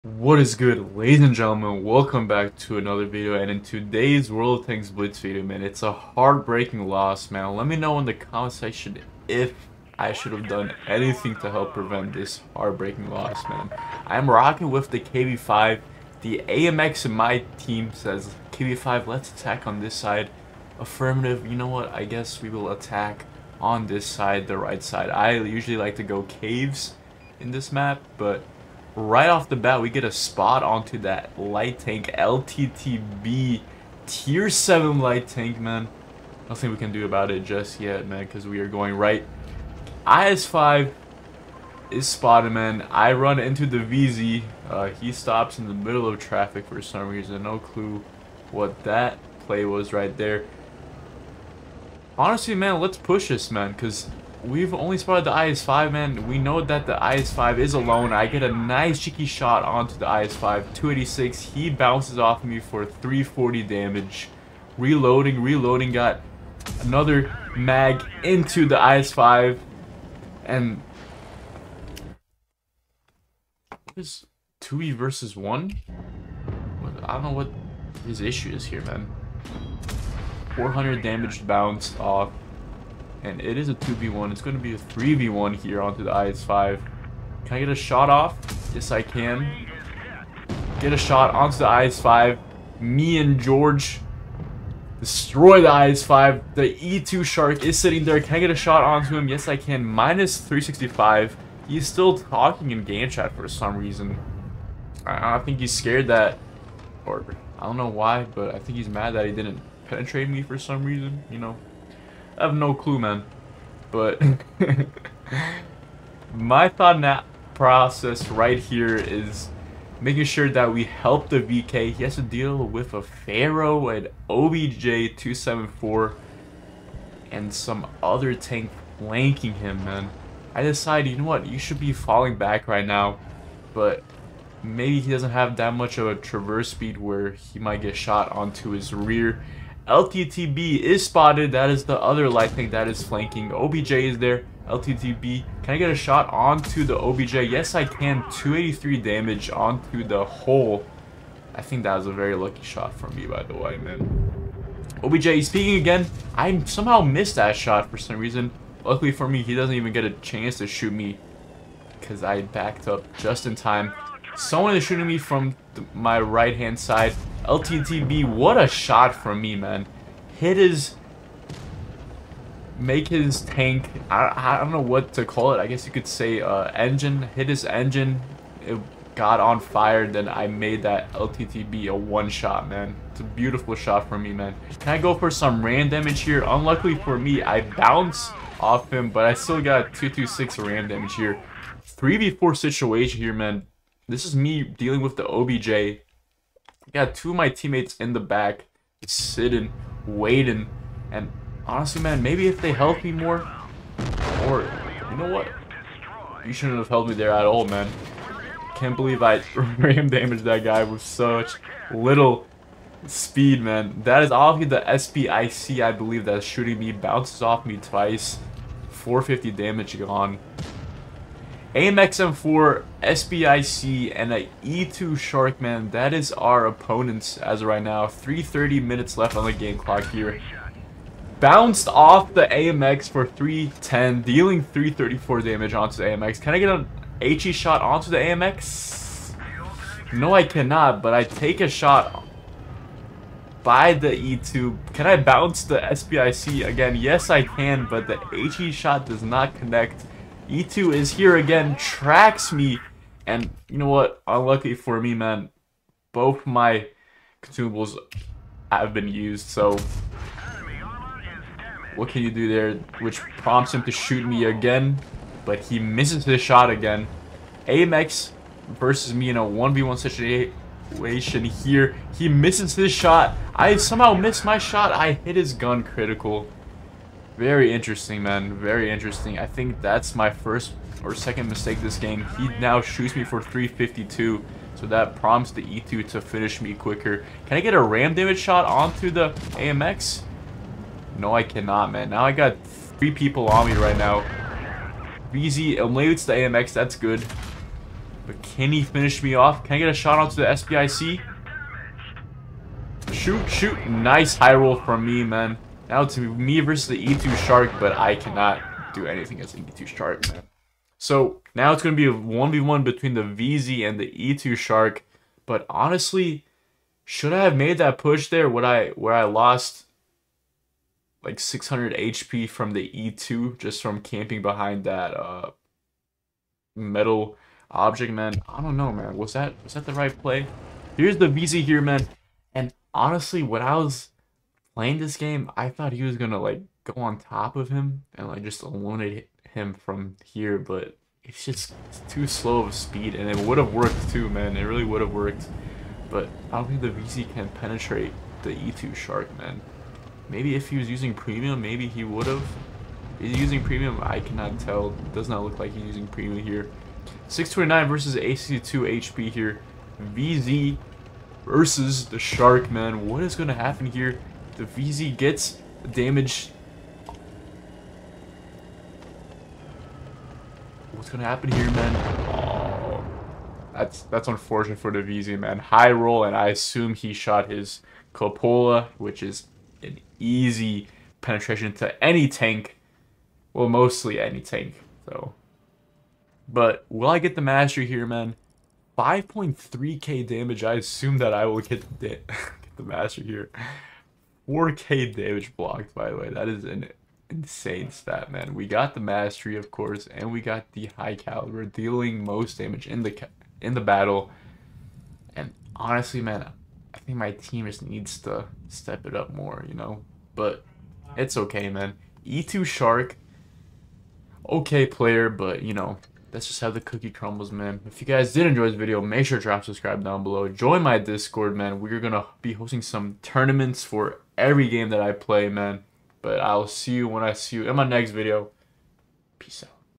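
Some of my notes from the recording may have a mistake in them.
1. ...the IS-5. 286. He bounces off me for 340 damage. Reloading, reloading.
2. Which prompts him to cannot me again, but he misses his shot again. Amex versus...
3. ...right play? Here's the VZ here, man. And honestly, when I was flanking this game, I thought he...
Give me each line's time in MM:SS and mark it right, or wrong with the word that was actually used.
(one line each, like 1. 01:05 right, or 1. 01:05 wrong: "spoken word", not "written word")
1. 00:59 right
2. 04:22 wrong: "shoot", not "cannot"
3. 05:29 wrong: "playing", not "flanking".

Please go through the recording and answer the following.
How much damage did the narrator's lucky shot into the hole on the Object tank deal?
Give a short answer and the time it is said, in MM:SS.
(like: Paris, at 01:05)
283, at 02:28.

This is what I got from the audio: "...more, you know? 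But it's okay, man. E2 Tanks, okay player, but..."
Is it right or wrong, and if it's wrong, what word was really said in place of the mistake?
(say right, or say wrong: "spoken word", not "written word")
wrong: "Shark", not "Tanks".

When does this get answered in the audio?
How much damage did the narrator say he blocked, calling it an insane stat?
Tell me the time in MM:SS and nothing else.
06:34.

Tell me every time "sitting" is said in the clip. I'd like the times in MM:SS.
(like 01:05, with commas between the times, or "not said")
01:37, 03:19.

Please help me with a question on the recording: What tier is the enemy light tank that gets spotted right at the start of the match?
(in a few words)
7.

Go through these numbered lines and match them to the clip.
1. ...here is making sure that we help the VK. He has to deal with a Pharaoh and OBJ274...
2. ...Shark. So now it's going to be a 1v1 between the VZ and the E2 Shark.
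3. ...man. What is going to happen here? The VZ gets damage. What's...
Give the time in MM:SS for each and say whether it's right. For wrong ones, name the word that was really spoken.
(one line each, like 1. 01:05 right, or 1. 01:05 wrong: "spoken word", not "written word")
1. 01:58 right
2. 05:09 right
3. 06:02 right.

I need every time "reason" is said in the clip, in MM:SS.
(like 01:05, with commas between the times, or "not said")
00:47, 01:43, 01:50, 02:38.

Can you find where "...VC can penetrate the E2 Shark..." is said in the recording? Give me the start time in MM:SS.
05:46.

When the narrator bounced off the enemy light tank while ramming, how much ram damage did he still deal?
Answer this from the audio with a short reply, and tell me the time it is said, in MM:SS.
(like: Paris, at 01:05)
226, at 03:09.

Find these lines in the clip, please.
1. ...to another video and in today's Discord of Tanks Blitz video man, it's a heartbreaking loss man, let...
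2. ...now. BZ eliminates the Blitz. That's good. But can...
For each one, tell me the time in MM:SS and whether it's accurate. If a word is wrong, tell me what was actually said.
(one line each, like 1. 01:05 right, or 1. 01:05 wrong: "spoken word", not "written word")
1. 00:02 wrong: "World", not "Discord"
2. 04:53 wrong: "AMX", not "Blitz".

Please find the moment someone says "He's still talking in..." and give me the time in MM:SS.
01:41.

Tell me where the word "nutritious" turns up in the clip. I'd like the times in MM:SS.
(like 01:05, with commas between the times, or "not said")
not said.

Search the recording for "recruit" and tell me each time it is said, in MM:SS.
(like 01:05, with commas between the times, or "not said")
not said.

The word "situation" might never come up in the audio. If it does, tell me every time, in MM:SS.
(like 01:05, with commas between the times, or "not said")
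03:12, 04:29.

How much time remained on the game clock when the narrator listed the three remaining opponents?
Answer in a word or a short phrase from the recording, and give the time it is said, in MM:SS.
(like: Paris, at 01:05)
3.30 minutes, at 03:48.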